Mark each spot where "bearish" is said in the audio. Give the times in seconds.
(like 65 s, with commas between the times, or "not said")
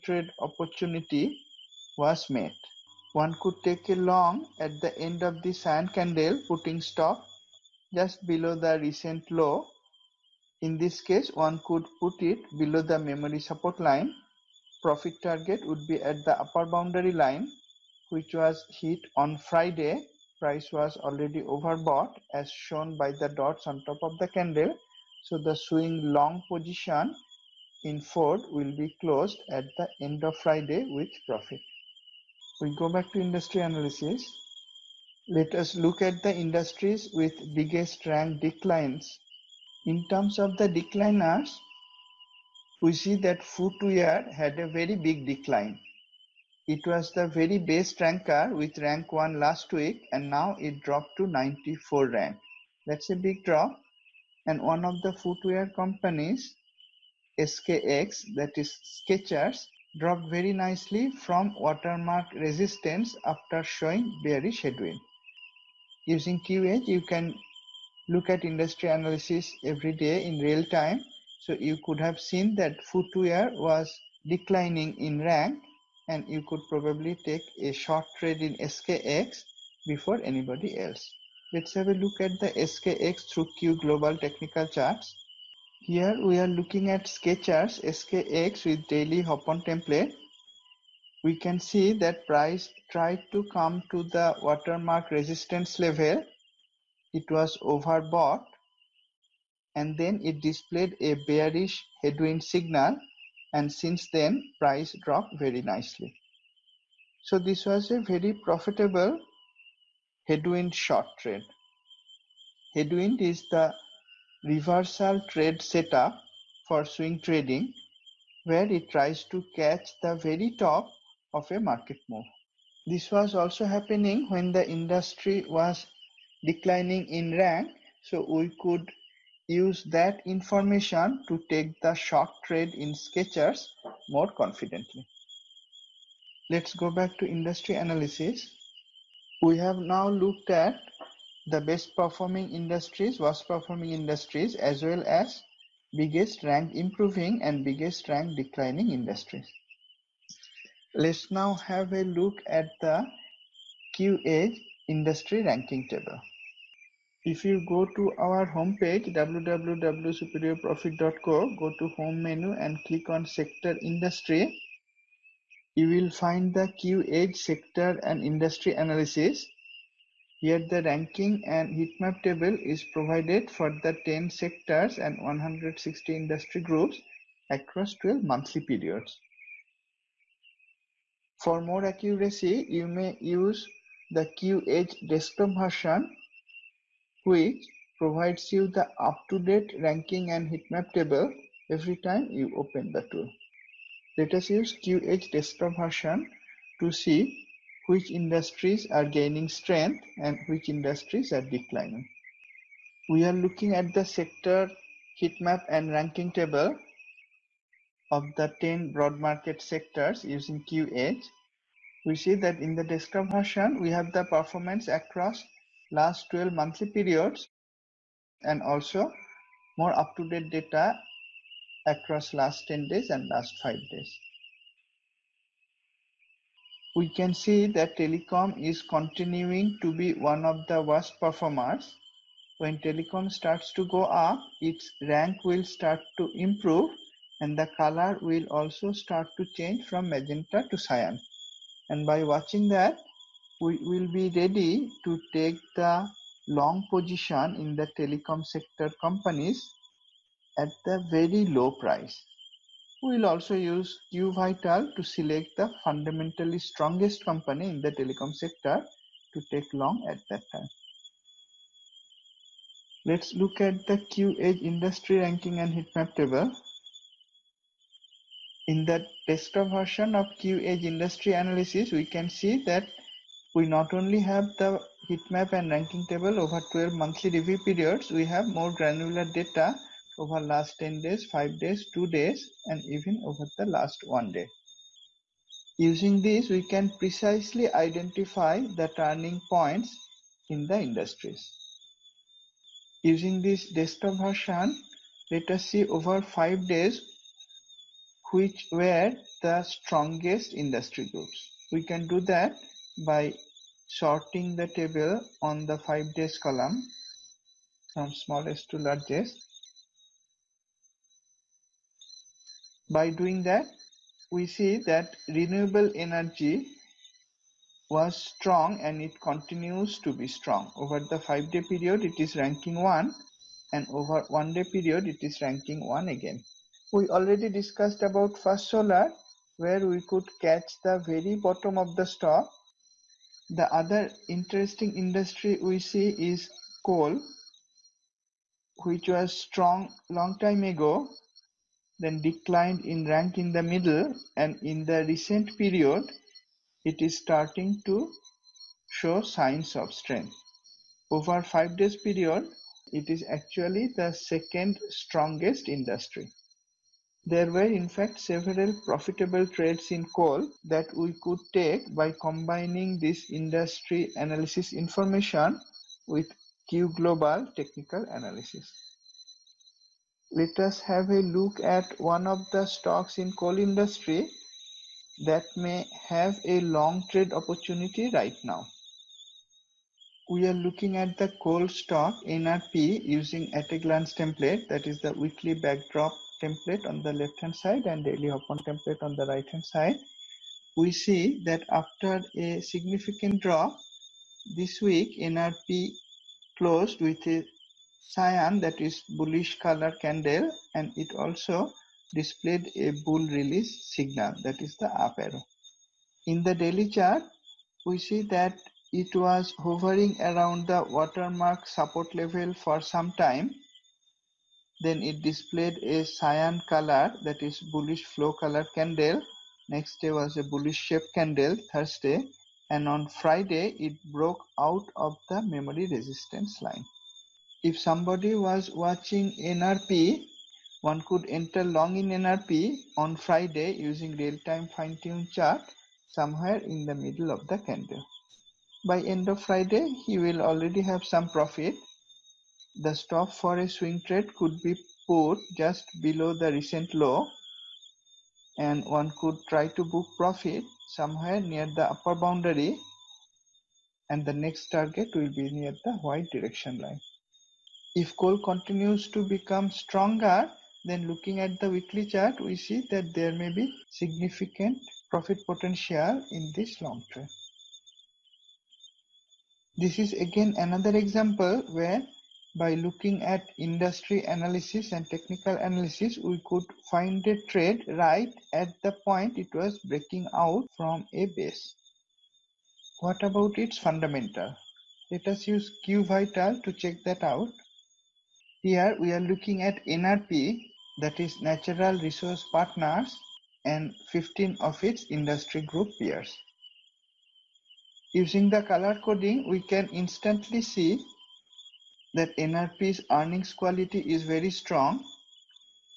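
64 s, 101 s.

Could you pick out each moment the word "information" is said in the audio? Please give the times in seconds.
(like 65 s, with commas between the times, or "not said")
130 s, 364 s.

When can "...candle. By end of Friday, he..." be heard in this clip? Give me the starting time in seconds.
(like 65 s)
437 s.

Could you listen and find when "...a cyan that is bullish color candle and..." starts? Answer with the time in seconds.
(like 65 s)
397 s.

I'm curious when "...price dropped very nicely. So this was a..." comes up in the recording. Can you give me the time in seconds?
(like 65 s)
104 s.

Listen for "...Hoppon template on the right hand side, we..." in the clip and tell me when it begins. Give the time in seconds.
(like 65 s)
388 s.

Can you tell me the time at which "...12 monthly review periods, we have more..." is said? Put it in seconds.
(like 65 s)
276 s.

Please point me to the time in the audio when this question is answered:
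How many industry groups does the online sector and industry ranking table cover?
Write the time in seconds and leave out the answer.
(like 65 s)
175 s.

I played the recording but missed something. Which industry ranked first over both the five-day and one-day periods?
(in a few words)
Renewable energy.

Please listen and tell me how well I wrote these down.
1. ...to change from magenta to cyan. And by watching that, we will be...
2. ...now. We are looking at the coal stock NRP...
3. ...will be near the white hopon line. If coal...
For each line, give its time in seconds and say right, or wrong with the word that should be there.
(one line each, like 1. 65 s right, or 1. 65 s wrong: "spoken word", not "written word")
1. 239 s right
2. 378 s right
3. 455 s wrong: "direction", not "hopon".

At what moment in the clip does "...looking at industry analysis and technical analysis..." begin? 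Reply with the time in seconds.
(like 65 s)
472 s.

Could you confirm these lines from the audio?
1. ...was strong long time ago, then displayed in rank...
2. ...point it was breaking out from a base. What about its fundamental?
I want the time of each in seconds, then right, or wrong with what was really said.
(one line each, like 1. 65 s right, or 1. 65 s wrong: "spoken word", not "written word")
1. 339 s wrong: "declined", not "displayed"
2. 479 s right.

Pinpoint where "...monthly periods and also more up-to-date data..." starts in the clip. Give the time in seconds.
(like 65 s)
216 s.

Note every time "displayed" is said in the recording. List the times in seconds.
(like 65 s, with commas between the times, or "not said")
100 s, 402 s, 415 s.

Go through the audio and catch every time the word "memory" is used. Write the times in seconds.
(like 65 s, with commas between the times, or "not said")
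12 s, 425 s.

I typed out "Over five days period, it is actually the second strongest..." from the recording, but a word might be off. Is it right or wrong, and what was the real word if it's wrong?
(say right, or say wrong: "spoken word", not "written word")
right.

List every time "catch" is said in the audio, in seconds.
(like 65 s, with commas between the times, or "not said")
119 s, 330 s.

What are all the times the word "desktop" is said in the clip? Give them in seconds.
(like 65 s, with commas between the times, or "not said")
185 s, 195 s, 212 s, 269 s, 293 s.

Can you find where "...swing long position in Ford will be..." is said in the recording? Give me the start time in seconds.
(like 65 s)
25 s.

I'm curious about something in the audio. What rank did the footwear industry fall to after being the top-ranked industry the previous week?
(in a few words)
94.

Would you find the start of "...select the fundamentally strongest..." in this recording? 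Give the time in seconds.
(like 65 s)
255 s.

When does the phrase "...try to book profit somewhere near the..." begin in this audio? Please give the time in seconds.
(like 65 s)
449 s.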